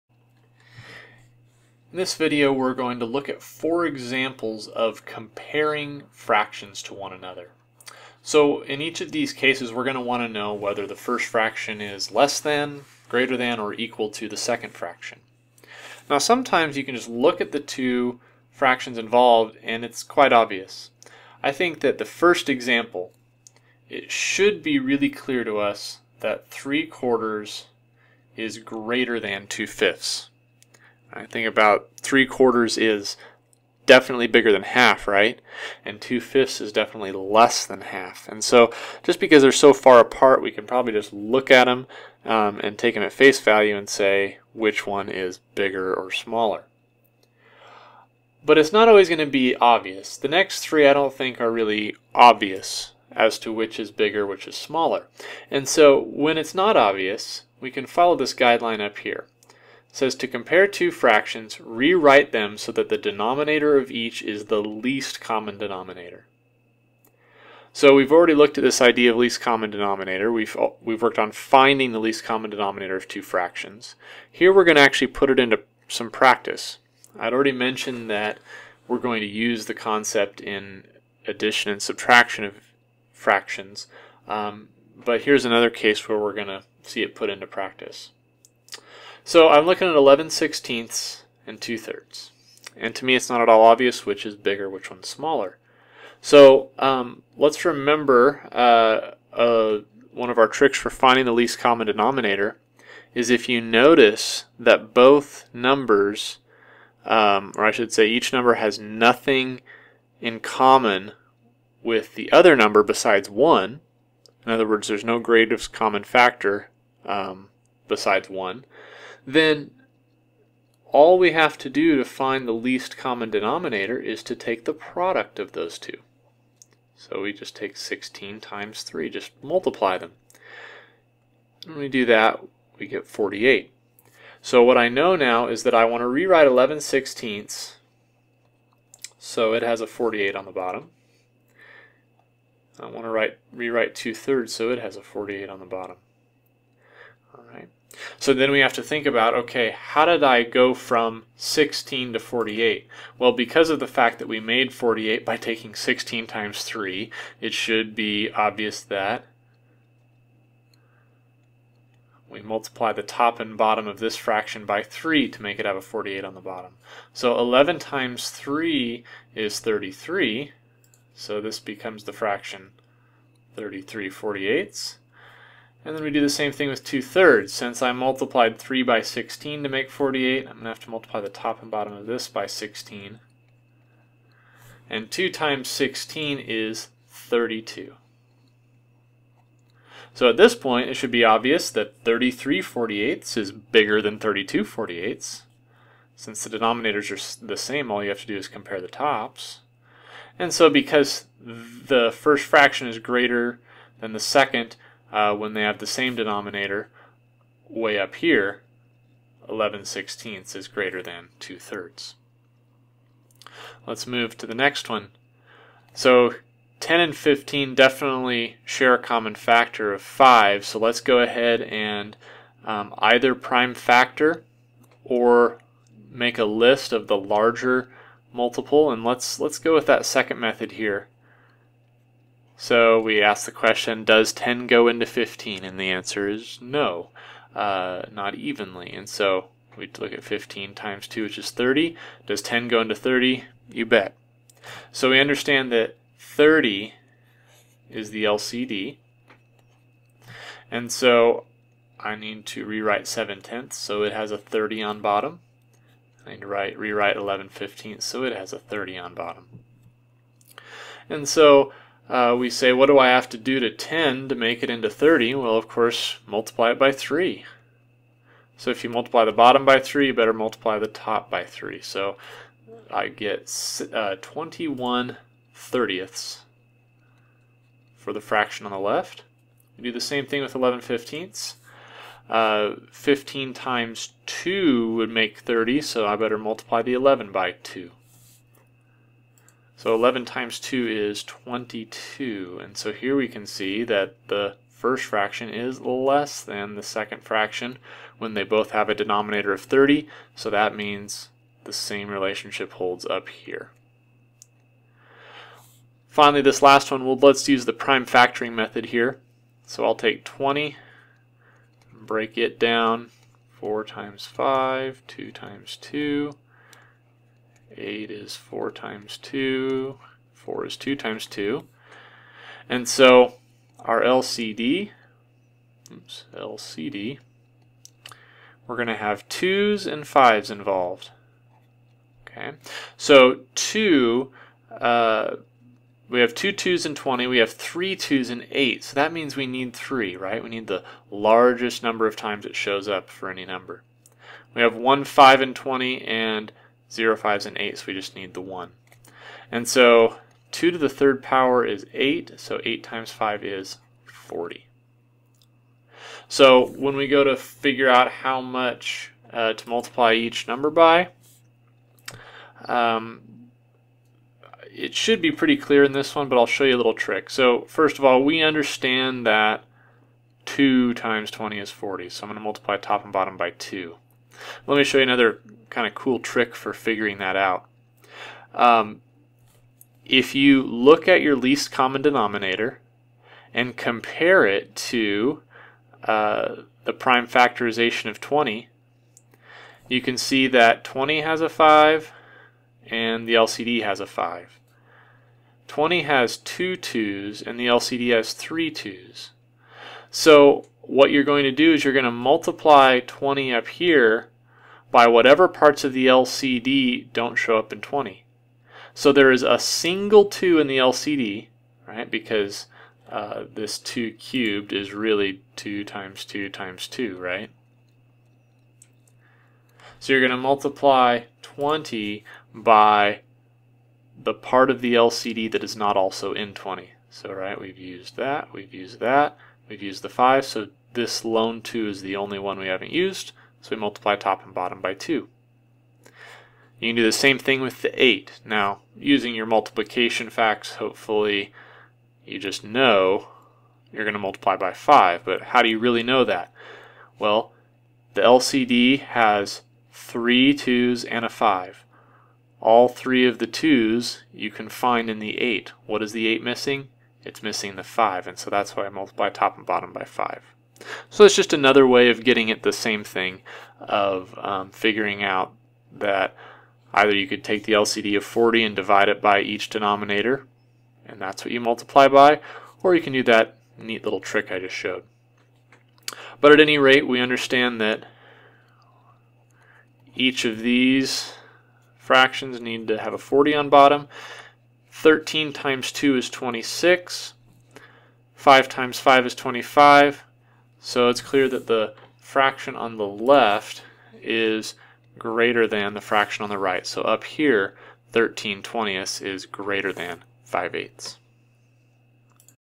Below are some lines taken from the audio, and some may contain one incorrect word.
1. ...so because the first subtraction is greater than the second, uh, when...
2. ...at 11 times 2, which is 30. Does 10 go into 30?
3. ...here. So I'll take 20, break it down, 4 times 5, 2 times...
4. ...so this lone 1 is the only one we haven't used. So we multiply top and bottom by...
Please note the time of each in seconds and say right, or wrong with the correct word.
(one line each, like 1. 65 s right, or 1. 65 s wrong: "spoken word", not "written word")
1. 200 s wrong: "fraction", not "subtraction"
2. 240 s wrong: "15", not "11"
3. 308 s right
4. 430 s wrong: "2", not "1".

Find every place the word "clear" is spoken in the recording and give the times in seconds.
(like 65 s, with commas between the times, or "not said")
25 s, 365 s, 491 s.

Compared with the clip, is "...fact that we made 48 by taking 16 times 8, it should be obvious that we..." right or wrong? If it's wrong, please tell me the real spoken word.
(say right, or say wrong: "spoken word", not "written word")
wrong: "3", not "8".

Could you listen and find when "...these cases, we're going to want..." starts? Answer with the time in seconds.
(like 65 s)
9 s.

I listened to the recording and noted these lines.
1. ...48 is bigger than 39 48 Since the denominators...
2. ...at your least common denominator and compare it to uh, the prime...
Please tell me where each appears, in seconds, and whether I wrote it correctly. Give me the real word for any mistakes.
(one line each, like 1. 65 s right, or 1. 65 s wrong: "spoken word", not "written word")
1. 192 s wrong: "32", not "39"
2. 381 s right.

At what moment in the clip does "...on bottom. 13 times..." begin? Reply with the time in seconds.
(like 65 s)
483 s.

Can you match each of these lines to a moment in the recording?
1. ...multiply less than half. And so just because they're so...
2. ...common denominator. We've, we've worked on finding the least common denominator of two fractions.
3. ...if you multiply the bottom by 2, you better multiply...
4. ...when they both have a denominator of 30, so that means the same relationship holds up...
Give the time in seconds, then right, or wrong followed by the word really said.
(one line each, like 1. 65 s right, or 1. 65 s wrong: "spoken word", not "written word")
1. 36 s wrong: "definitely", not "multiply"
2. 69 s right
3. 268 s wrong: "3", not "2"
4. 298 s right.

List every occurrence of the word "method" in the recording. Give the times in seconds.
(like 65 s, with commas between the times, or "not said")
230 s, 308 s.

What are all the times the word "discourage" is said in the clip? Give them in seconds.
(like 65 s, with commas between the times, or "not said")
not said.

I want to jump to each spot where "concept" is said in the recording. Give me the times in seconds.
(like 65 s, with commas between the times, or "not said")
79 s.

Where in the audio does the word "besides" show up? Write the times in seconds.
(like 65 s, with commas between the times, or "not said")
112 s, 117 s.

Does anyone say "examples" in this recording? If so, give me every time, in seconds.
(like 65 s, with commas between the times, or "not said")
3 s, 22 s.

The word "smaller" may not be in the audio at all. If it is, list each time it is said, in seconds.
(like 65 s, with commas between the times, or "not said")
46 s, 54 s, 95 s.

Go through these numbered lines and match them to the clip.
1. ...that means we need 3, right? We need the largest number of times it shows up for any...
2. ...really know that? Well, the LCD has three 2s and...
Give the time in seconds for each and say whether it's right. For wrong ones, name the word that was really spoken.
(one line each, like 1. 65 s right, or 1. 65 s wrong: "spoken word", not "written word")
1. 338 s right
2. 445 s right.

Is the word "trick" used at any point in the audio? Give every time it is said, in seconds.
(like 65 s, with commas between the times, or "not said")
100 s, 366 s, 376 s, 474 s.